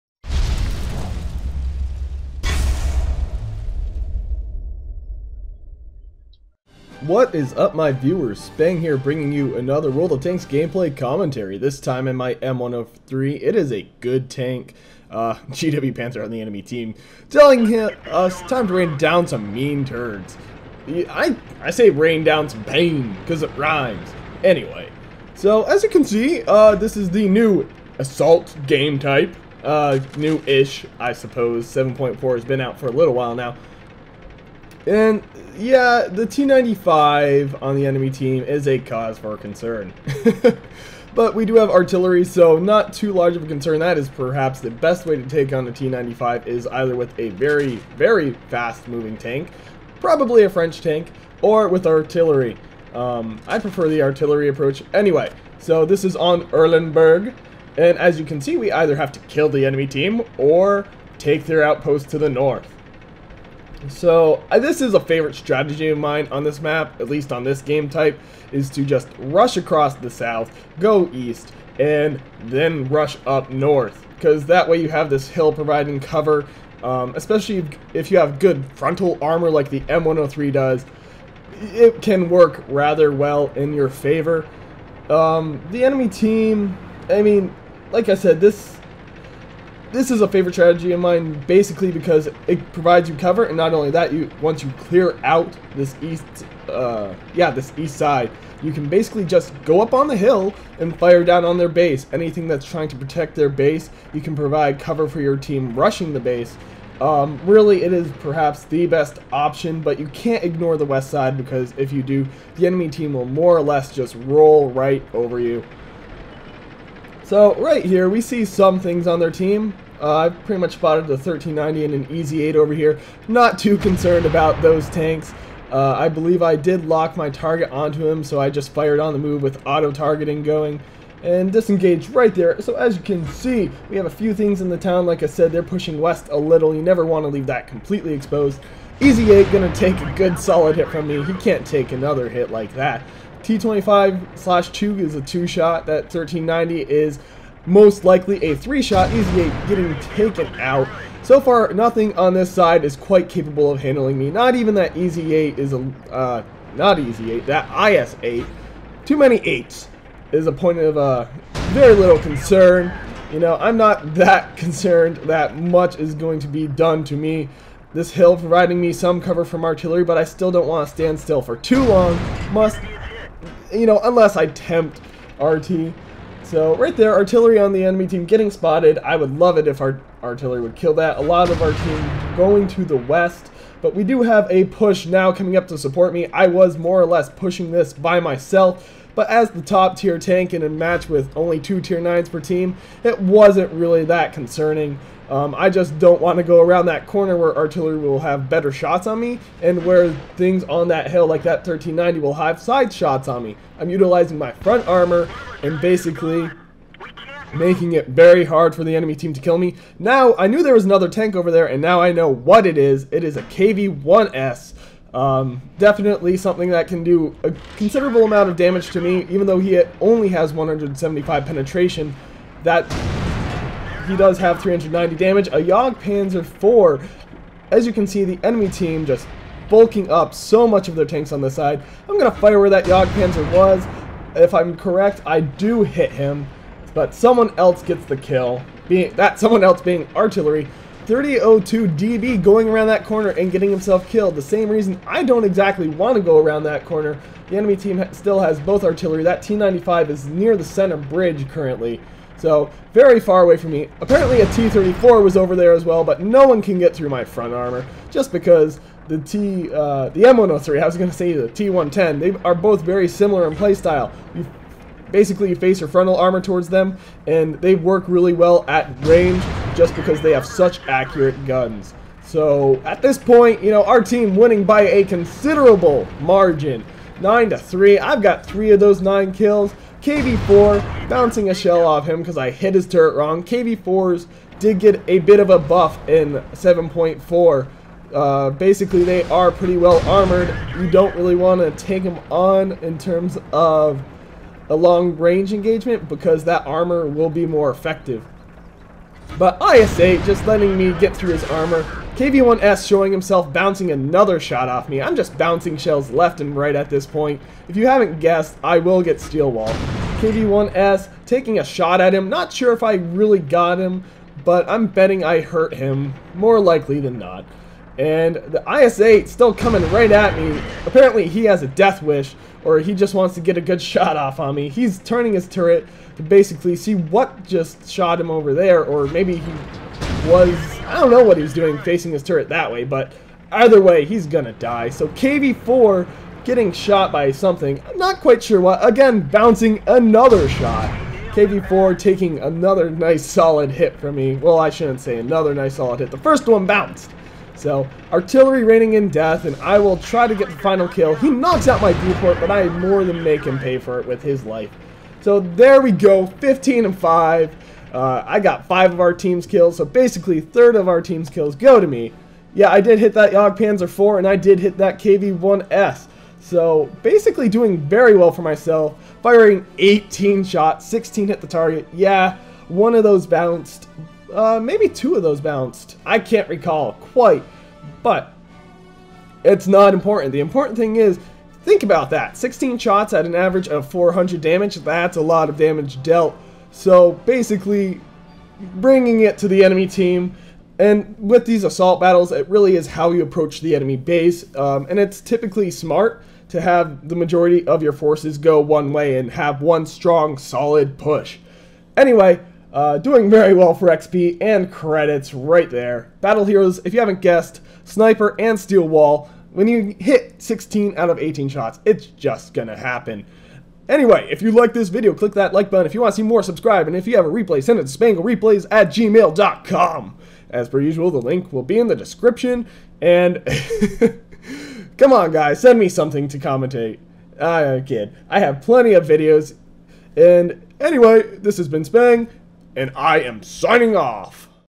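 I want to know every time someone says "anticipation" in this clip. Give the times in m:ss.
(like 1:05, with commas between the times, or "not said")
not said.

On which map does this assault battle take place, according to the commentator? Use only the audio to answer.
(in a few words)
Erlenberg.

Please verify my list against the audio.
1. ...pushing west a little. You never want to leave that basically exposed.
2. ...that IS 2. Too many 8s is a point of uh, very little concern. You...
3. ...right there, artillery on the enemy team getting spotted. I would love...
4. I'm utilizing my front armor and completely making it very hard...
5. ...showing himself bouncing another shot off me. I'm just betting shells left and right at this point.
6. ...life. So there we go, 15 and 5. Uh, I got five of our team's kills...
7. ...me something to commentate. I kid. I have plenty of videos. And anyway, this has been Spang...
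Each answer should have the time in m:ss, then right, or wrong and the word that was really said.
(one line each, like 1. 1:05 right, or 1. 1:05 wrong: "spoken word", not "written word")
1. 2:15 wrong: "completely", not "basically"
2. 2:37 wrong: "8", not "2"
3. 2:56 right
4. 3:23 wrong: "basically", not "completely"
5. 5:02 wrong: "bouncing", not "betting"
6. 5:54 right
7. 7:05 right.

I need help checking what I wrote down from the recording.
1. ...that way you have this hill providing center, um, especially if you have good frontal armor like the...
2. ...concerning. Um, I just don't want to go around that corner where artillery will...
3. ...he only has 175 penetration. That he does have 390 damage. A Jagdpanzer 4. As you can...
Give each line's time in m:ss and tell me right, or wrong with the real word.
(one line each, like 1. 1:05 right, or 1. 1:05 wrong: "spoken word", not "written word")
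1. 1:14 wrong: "cover", not "center"
2. 3:14 right
3. 3:39 right.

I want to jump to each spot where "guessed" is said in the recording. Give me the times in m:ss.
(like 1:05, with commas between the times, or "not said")
5:08, 6:47.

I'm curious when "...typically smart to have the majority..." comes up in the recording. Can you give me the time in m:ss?
6:35.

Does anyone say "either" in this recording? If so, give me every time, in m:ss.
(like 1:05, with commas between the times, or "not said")
0:46, 0:58, 5:33.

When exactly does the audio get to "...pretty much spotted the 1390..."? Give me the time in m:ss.
2:00.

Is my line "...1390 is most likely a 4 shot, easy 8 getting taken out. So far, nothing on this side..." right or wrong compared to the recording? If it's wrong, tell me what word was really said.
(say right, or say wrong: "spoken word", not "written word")
wrong: "3", not "4".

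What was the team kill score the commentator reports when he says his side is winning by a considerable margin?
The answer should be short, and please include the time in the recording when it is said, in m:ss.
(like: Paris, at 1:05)
9 to 3, at 4:37.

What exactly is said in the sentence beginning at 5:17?
And the IS-8 still coming right at me.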